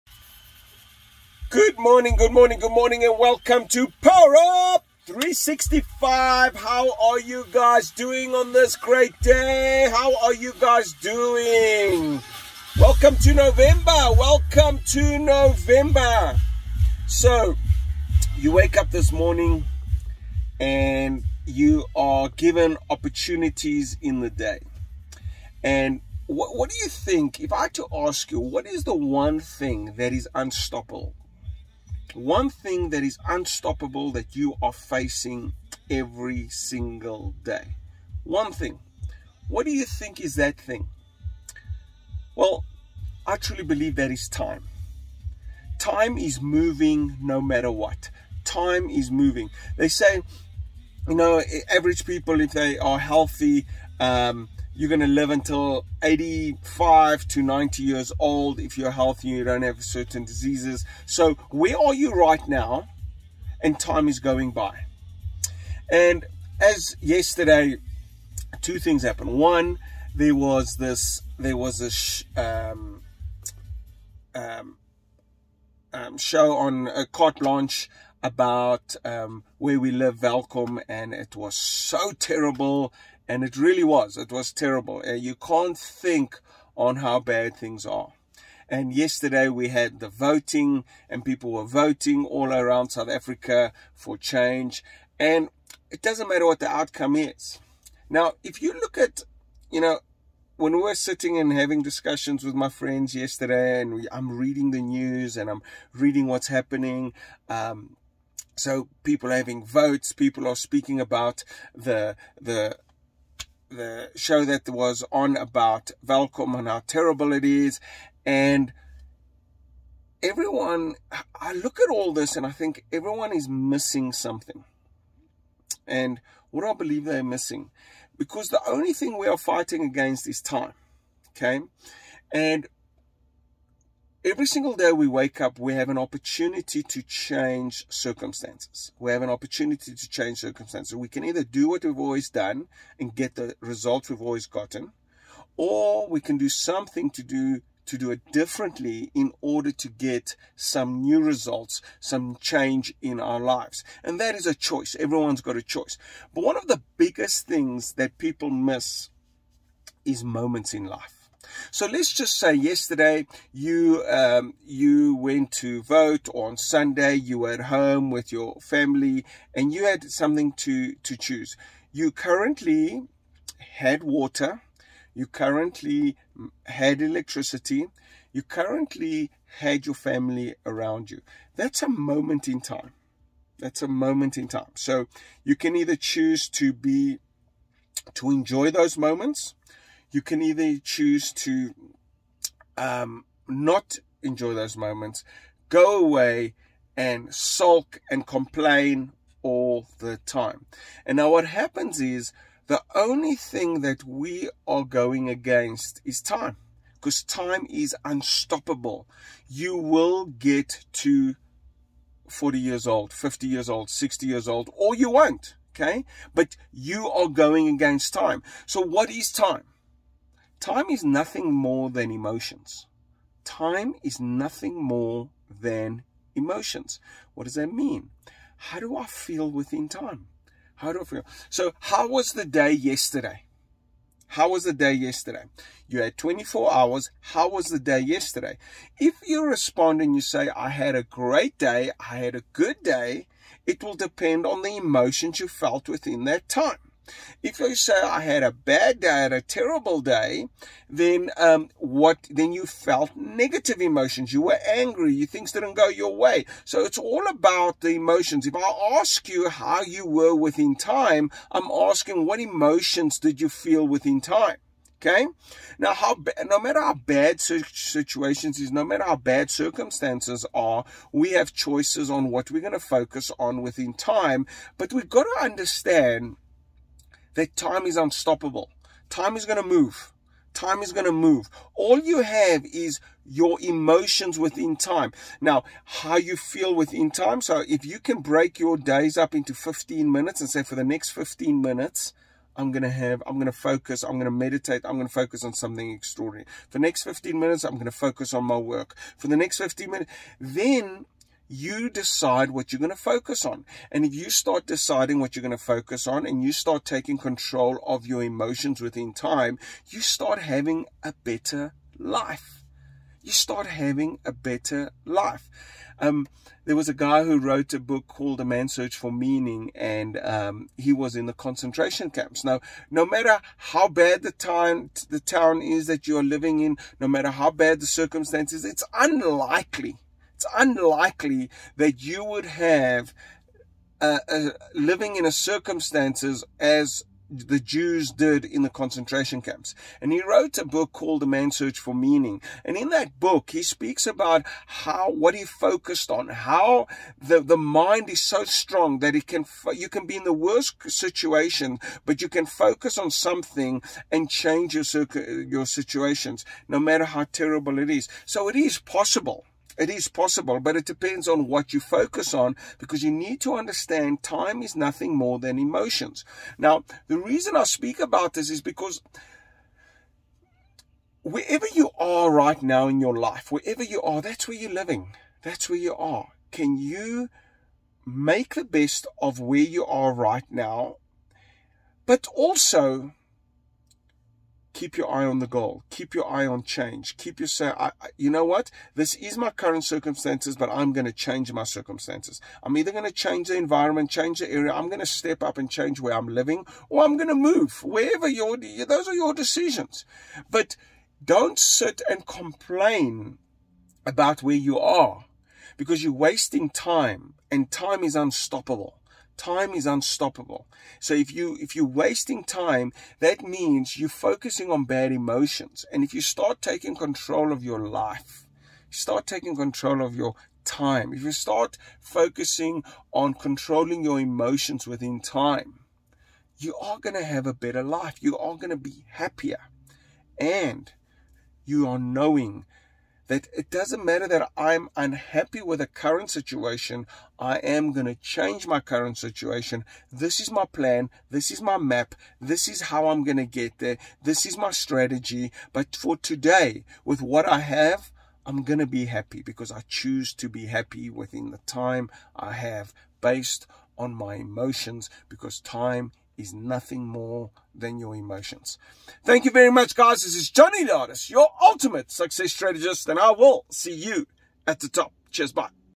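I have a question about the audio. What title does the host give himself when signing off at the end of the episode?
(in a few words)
Ultimate success strategist.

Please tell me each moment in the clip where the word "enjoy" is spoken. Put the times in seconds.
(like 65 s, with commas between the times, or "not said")
188 s, 194 s.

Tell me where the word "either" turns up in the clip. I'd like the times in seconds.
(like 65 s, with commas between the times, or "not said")
141 s, 185 s, 190 s, 392 s.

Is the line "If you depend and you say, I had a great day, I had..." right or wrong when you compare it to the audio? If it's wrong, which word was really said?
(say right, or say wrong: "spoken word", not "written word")
wrong: "respond", not "depend".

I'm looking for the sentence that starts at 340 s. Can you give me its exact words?
And he wrote a book called The Man's Search for Meaning.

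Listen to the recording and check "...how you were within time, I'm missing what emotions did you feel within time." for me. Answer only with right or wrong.
wrong.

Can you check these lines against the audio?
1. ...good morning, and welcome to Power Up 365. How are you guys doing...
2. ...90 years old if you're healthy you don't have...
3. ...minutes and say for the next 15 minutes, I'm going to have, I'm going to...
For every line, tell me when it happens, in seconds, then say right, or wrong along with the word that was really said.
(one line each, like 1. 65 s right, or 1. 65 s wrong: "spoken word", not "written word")
1. 2 s right
2. 57 s right
3. 290 s right.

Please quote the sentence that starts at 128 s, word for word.
Because the only thing we are fighting against is time.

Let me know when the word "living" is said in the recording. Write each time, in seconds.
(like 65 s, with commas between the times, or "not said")
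326 s, 334 s, 374 s, 396 s.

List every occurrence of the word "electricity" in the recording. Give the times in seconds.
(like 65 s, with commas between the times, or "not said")
177 s.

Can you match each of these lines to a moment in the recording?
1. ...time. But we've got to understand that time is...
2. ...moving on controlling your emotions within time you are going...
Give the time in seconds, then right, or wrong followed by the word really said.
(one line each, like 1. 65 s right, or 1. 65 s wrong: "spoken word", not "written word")
1. 273 s right
2. 421 s wrong: "focusing", not "moving".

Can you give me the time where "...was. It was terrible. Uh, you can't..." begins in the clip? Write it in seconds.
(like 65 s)
83 s.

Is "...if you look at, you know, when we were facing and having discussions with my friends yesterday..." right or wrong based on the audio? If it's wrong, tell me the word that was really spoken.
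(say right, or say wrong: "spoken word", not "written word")
wrong: "sitting", not "facing".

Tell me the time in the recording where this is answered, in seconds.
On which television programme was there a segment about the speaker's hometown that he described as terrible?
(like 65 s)
77 s.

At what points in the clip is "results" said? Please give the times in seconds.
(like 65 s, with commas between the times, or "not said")
143 s, 151 s.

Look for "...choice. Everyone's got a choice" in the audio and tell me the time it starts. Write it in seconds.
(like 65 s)
154 s.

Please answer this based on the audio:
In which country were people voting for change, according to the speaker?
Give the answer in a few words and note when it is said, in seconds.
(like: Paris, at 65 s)
South Africa, at 92 s.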